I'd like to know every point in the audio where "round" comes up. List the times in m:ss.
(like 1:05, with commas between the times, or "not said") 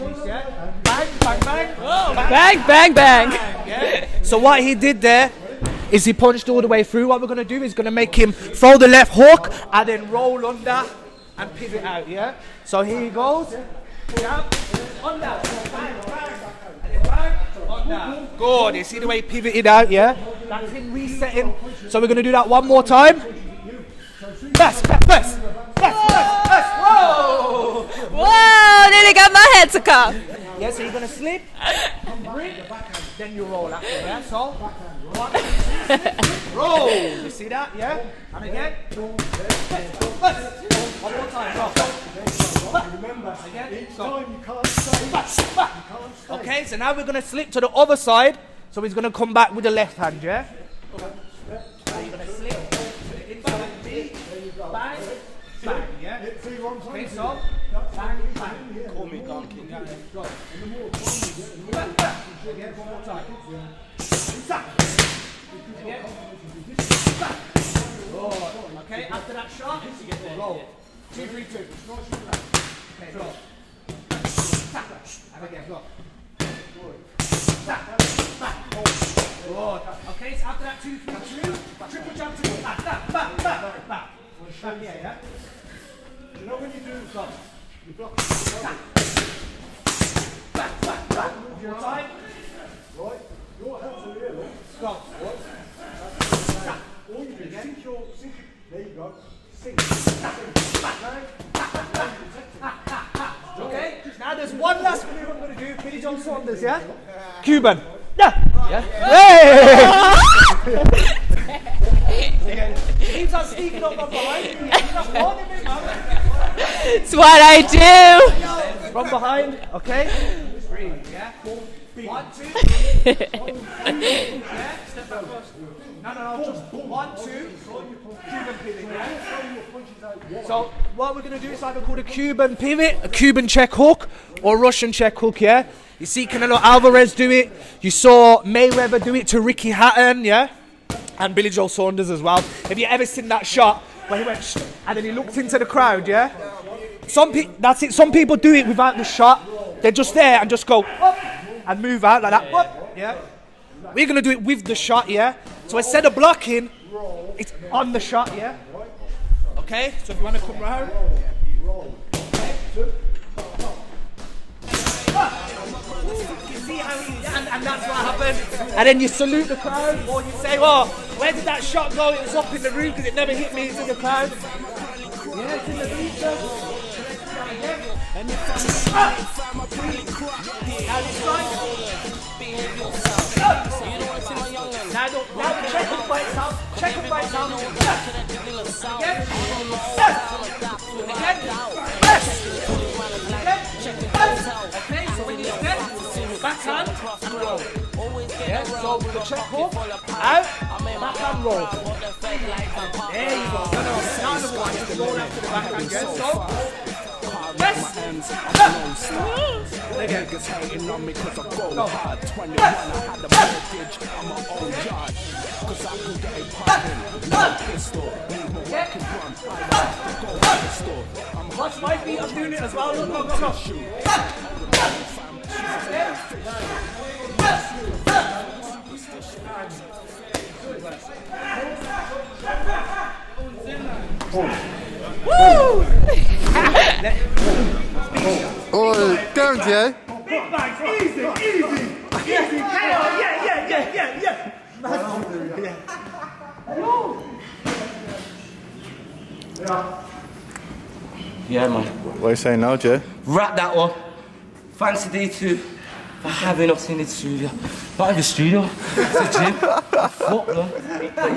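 2:40.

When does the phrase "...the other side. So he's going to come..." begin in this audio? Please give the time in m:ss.
0:47.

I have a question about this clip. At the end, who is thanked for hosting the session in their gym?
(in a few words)
D2.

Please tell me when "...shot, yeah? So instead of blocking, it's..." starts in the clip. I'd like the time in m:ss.
2:34.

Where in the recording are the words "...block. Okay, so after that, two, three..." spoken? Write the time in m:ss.
1:15.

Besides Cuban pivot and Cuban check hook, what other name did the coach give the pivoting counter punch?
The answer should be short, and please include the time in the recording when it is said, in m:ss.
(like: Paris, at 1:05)
Russian check hook, at 2:14.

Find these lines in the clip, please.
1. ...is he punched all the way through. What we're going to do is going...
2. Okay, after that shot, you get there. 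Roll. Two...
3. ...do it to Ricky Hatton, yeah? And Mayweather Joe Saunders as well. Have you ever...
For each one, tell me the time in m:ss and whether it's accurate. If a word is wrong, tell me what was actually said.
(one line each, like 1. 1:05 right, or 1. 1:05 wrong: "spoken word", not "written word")
1. 0:05 right
2. 1:08 right
3. 2:19 wrong: "Billy", not "Mayweather".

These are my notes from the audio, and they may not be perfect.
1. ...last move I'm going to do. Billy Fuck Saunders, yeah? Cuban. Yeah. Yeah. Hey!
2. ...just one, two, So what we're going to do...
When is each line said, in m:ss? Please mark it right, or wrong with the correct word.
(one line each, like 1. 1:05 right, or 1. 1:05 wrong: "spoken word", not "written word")
1. 1:44 wrong: "John", not "Fuck"
2. 2:06 right.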